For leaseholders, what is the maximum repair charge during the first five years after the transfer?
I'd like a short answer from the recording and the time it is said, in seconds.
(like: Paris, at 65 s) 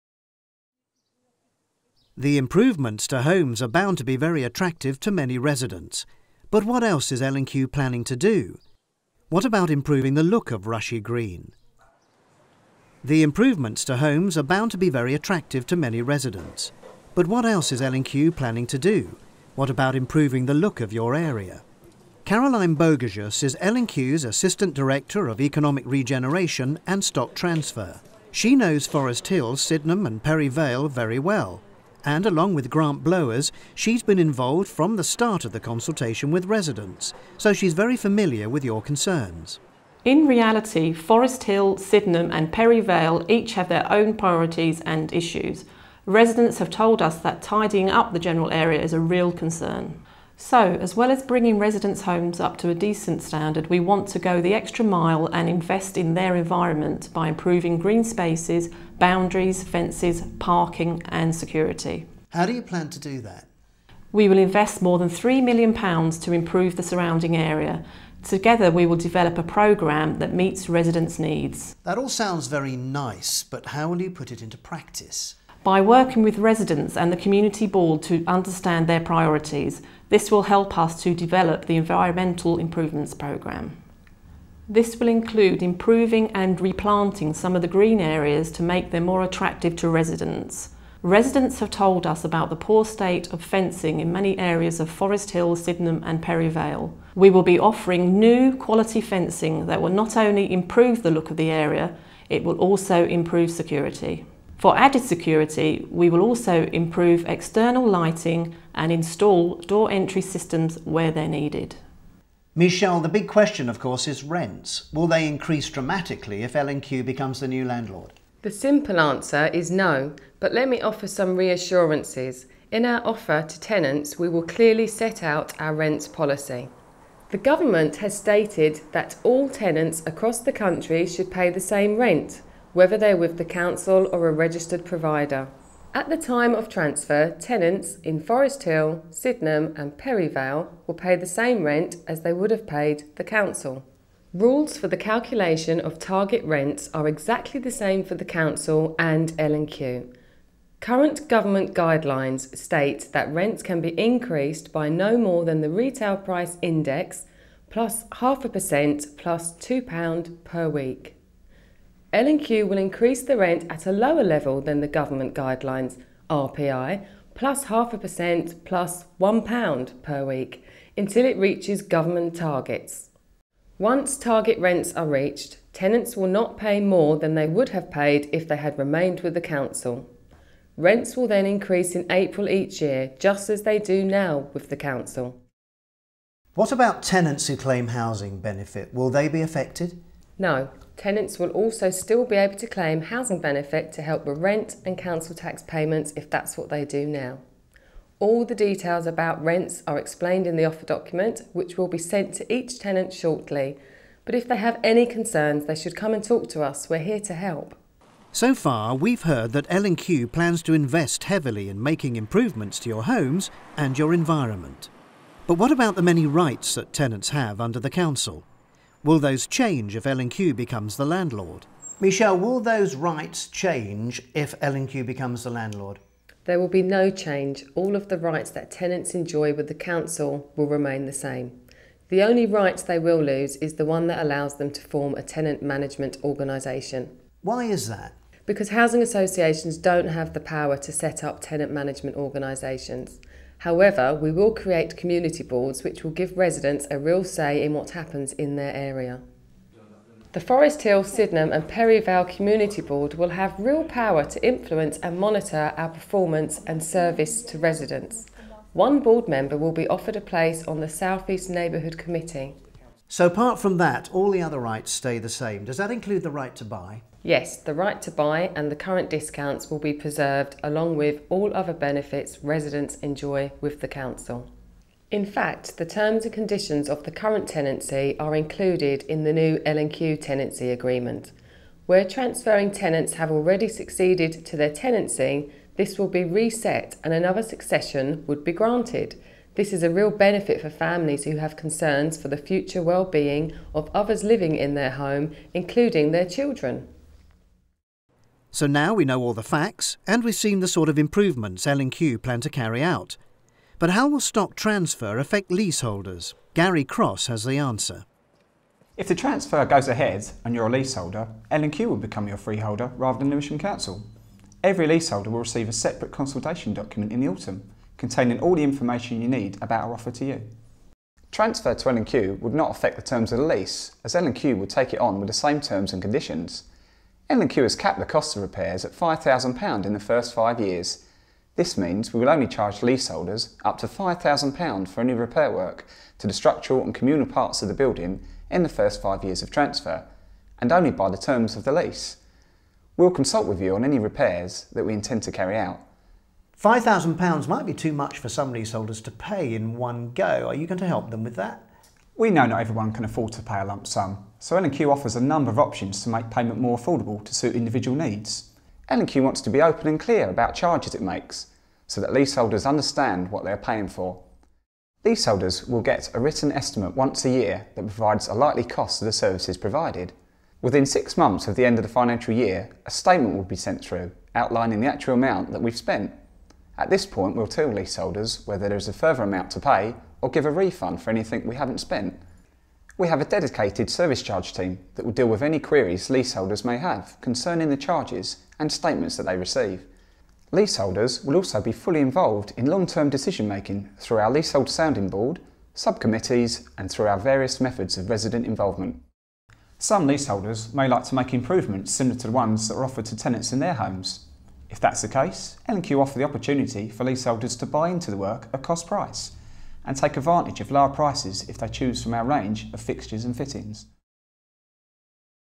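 £5,000, at 328 s.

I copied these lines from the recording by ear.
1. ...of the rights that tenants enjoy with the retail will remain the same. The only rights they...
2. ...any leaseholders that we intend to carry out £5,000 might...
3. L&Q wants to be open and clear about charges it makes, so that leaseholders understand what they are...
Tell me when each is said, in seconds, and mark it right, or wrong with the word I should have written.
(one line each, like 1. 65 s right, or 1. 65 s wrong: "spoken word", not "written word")
1. 227 s wrong: "council", not "retail"
2. 343 s wrong: "repairs", not "leaseholders"
3. 358 s right.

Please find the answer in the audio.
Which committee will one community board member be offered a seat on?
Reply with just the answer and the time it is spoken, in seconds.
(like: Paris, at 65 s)
South East Neighbourhood Committee, at 260 s.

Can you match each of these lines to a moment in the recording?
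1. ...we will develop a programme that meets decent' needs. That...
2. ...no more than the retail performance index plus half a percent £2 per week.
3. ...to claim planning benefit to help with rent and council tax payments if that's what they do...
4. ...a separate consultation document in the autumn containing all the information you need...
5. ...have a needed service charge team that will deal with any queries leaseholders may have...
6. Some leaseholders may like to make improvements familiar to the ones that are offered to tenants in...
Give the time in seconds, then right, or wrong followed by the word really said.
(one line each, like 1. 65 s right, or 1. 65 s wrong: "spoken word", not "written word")
1. 68 s wrong: "residents", not "decent"
2. 154 s wrong: "price", not "performance"
3. 192 s wrong: "housing", not "planning"
4. 315 s right
5. 383 s wrong: "dedicated", not "needed"
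6. 399 s wrong: "similar", not "familiar".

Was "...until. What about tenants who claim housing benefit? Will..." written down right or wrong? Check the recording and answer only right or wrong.
wrong.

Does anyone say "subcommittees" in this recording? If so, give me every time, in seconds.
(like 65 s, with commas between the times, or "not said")
395 s.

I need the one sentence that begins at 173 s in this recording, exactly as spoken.
Once target rents are reached, tenants will not pay more than they would have paid if they had remained with the council.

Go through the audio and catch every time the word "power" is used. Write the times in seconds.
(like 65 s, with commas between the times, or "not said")
240 s, 253 s.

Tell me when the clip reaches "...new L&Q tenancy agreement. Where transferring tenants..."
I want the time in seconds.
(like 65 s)
279 s.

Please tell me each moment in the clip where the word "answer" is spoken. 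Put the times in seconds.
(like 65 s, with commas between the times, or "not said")
118 s, 307 s.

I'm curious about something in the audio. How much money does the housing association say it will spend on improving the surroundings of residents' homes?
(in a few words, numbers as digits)
More than £3 million.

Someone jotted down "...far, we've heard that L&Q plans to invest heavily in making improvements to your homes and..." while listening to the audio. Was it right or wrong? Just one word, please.
right.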